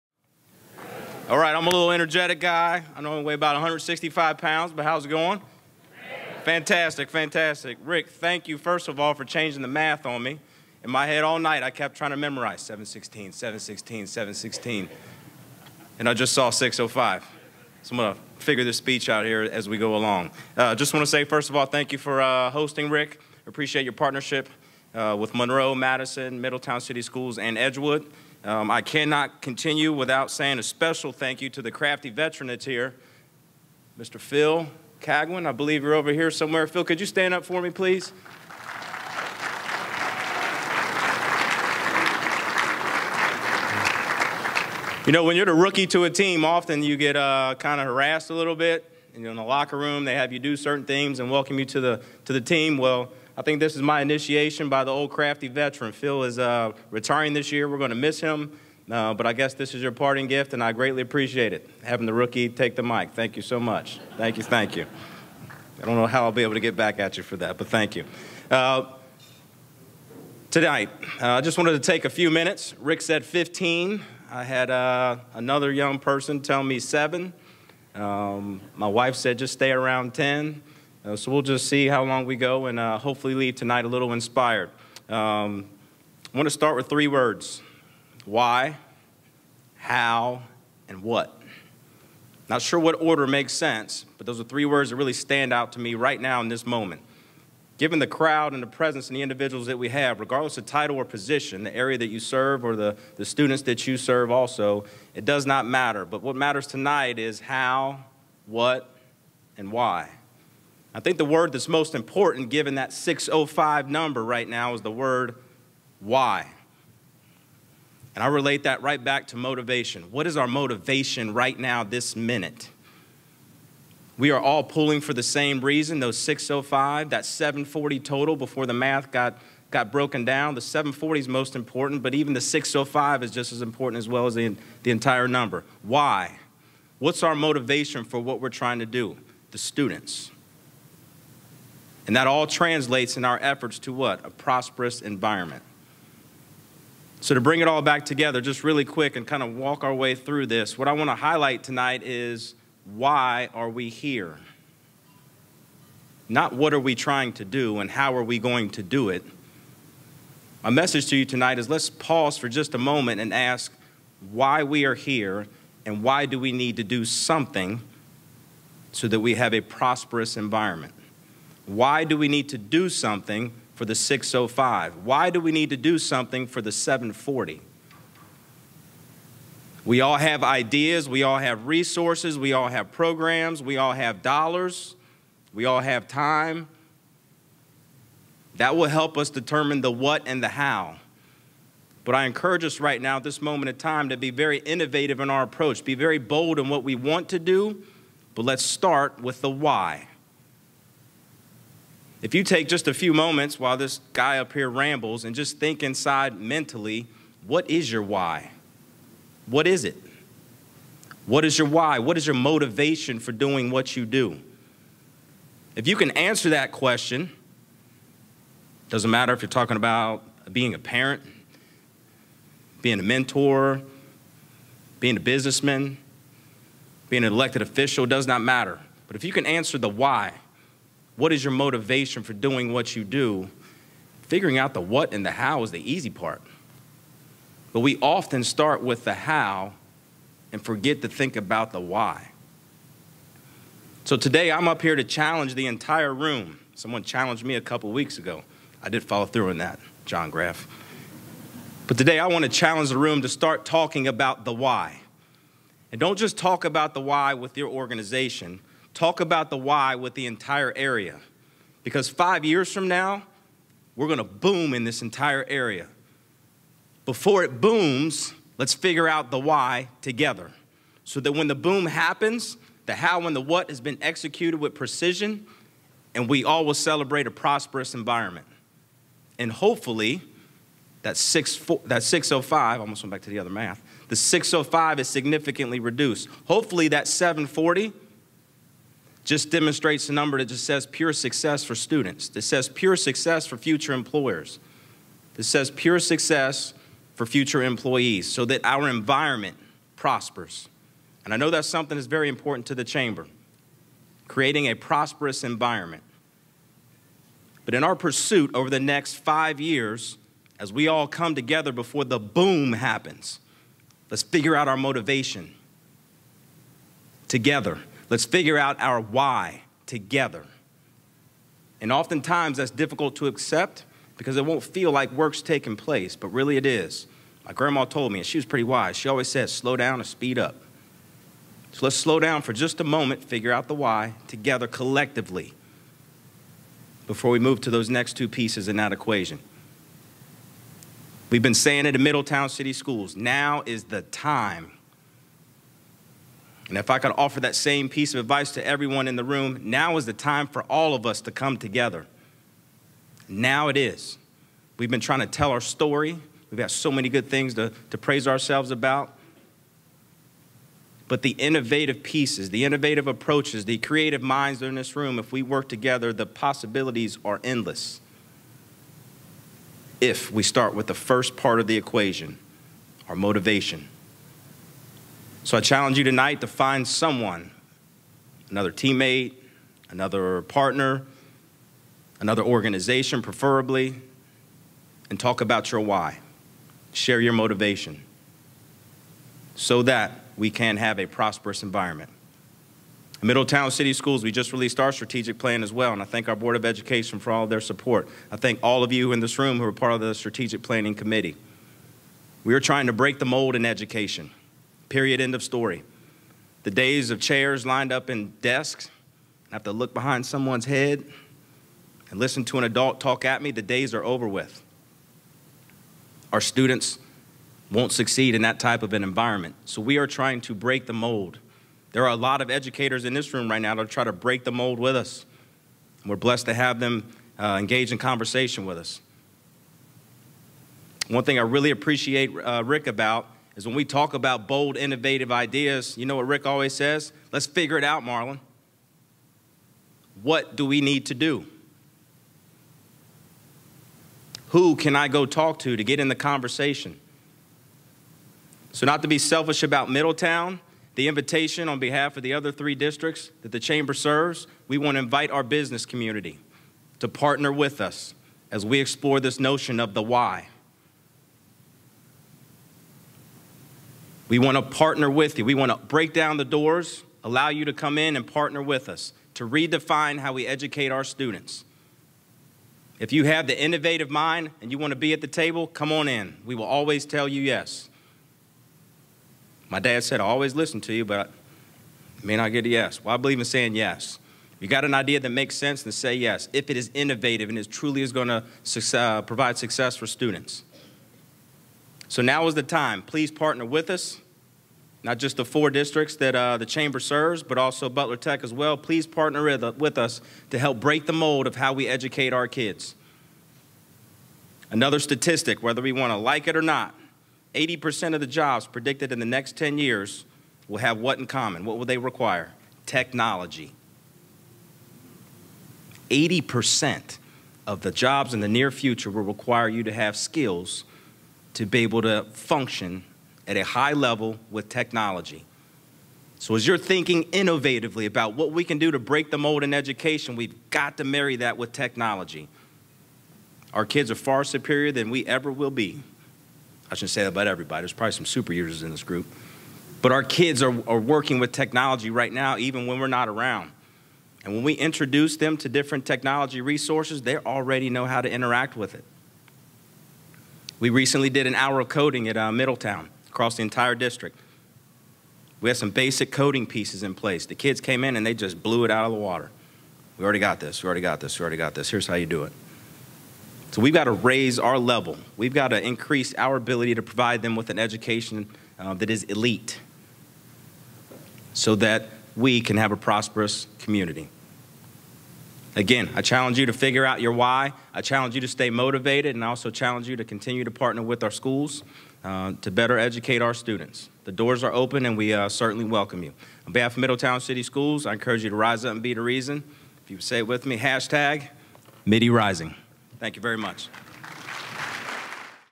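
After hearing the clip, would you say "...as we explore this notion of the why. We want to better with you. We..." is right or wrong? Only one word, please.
wrong.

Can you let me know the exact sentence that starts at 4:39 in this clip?
And hopefully, that, six, that 605, I almost went back to the other math, the 605 is significantly reduced.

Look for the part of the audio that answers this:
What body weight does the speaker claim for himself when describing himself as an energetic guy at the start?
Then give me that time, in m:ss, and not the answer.
0:03.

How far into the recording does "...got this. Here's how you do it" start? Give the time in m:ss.
9:21.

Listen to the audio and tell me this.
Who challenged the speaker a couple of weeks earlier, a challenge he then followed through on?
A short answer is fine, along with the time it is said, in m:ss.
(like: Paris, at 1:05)
John Graff, at 4:10.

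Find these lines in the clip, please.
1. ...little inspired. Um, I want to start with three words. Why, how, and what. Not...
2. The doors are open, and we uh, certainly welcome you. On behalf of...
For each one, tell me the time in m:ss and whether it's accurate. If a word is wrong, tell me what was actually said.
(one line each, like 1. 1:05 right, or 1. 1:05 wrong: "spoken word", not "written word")
1. 1:23 right
2. 9:44 right.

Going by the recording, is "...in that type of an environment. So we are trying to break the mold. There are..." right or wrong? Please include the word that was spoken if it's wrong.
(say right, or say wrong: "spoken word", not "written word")
right.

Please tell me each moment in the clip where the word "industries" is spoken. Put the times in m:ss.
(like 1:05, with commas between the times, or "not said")
not said.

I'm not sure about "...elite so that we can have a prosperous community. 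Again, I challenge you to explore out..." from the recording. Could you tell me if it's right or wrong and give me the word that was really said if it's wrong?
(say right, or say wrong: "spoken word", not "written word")
wrong: "figure", not "explore".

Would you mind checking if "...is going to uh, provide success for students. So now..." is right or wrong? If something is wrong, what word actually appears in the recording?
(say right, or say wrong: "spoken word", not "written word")
right.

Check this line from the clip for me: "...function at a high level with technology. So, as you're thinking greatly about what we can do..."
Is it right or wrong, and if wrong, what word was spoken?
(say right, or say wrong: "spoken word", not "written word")
wrong: "innovatively", not "greatly".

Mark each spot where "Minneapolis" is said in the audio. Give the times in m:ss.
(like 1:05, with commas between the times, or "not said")
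not said.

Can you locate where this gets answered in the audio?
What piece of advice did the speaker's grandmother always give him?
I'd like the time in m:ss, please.
5:29.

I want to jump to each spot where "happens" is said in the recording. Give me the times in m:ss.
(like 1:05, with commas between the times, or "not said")
4:31, 5:12.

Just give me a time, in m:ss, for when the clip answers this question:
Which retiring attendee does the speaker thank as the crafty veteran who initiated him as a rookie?
0:34.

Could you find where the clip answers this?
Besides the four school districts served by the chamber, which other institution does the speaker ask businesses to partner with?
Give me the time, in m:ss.
8:17.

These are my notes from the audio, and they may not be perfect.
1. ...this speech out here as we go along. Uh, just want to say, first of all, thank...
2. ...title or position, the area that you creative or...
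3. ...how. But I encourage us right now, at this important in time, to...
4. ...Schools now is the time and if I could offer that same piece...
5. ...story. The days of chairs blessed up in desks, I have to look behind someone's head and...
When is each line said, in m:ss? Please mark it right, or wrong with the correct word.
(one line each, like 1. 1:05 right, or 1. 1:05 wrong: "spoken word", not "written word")
1. 0:18 right
2. 1:40 wrong: "serve", not "creative"
3. 3:10 wrong: "moment", not "important"
4. 5:42 right
5. 6:45 wrong: "lined", not "blessed".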